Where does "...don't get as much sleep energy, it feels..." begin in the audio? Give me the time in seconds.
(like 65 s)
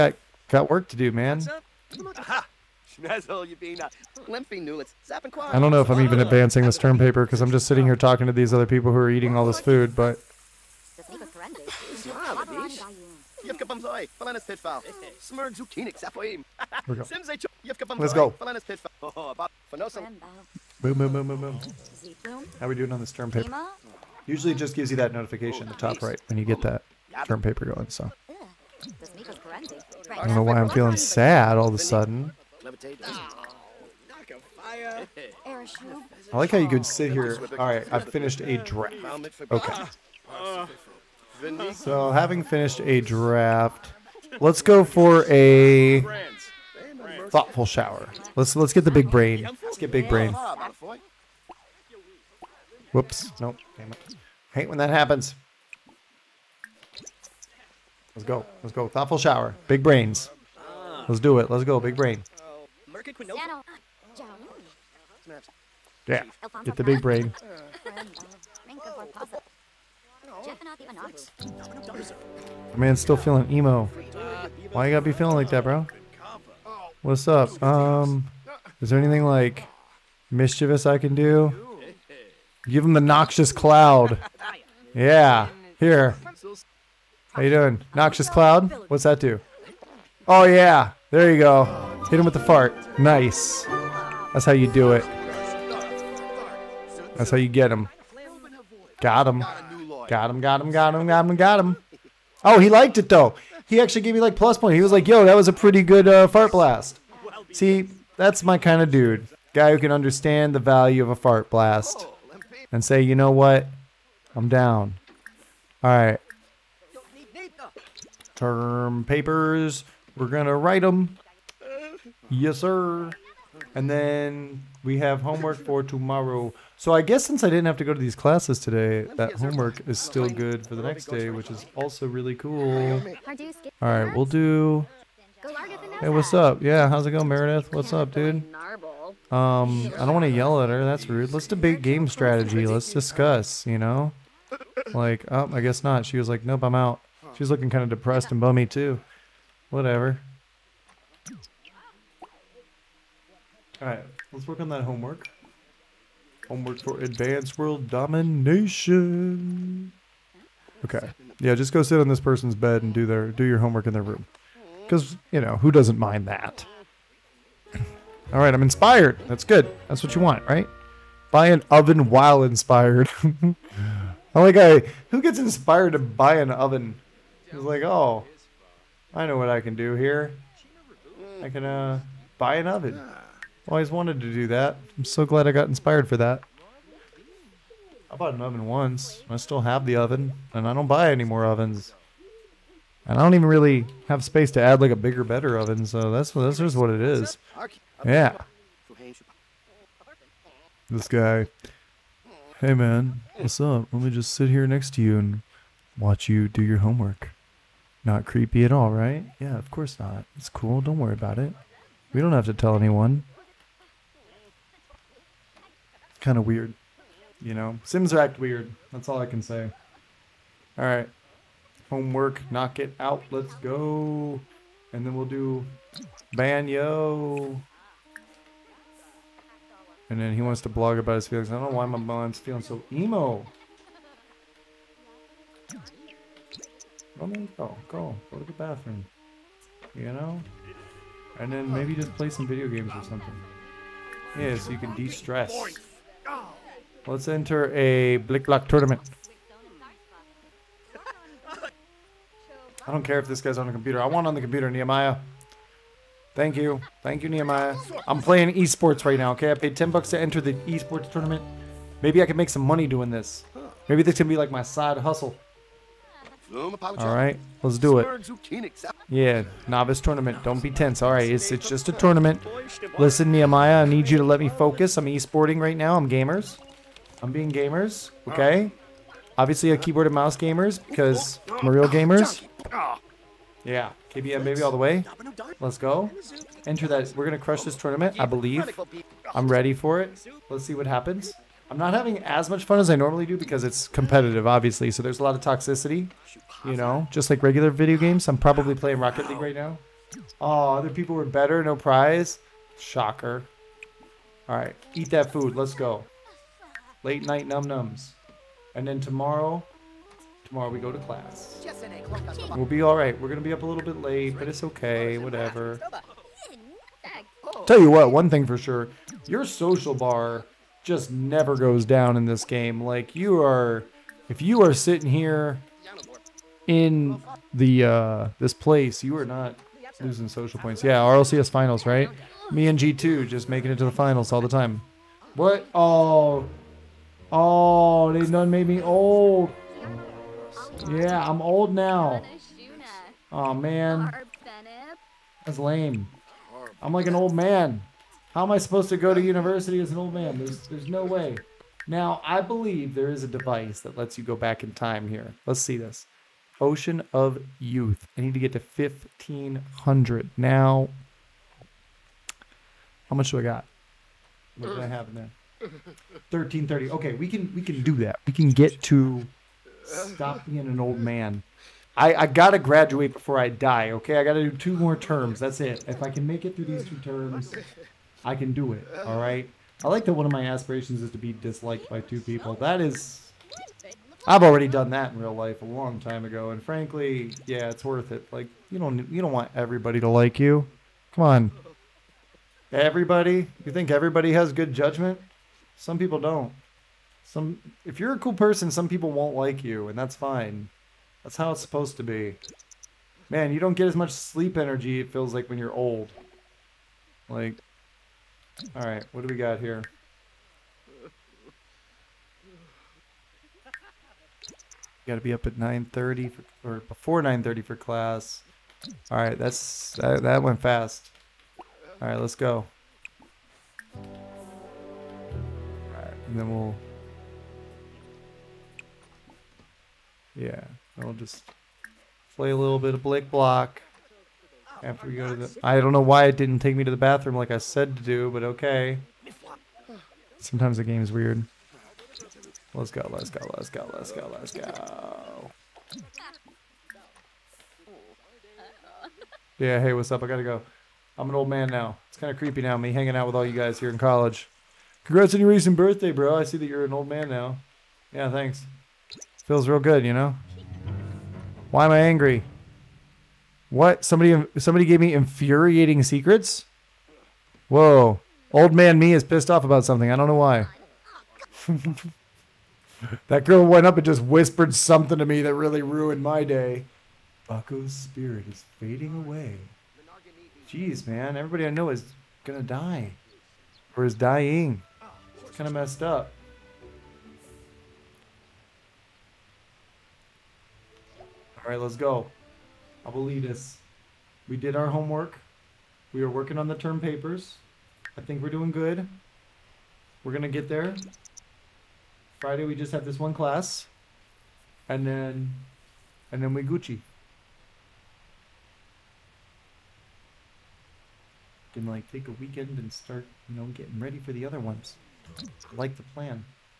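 403 s.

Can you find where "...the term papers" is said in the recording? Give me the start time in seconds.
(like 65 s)
496 s.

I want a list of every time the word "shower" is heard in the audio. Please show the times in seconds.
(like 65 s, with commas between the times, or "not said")
47 s, 59 s.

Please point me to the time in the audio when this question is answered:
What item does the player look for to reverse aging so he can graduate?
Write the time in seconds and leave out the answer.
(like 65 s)
356 s.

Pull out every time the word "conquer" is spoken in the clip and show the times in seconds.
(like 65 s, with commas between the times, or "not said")
not said.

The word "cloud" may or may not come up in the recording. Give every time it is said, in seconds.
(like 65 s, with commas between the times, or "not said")
83 s, 88 s.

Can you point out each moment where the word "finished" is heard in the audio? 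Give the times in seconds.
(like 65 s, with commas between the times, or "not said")
38 s, 42 s.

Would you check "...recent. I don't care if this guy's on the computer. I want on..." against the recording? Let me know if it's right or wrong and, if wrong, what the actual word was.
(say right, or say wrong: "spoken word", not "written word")
wrong: "tournament", not "recent".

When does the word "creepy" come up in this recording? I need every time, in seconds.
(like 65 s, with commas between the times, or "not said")
208 s, 452 s.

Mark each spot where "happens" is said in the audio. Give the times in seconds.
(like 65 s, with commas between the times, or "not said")
54 s, 290 s.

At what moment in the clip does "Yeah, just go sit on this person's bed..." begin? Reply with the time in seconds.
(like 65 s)
161 s.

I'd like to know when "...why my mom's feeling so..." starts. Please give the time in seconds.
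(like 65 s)
231 s.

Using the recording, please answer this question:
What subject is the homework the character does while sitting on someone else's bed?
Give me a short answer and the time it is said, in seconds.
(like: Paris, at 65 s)
Advanced world domination, at 156 s.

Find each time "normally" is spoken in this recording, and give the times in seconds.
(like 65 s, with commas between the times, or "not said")
292 s.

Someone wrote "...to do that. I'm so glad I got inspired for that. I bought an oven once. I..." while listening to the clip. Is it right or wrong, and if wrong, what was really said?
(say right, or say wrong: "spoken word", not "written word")
right.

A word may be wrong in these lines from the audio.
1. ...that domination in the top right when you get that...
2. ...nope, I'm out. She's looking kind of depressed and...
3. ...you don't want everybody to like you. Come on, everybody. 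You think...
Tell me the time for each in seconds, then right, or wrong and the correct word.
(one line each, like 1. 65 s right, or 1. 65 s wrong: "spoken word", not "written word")
1. 24 s wrong: "notification", not "domination"
2. 146 s right
3. 389 s right.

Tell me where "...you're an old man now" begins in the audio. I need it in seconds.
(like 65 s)
456 s.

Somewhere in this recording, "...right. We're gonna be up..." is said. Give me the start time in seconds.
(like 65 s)
312 s.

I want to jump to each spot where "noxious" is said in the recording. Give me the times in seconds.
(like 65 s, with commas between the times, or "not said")
82 s, 87 s.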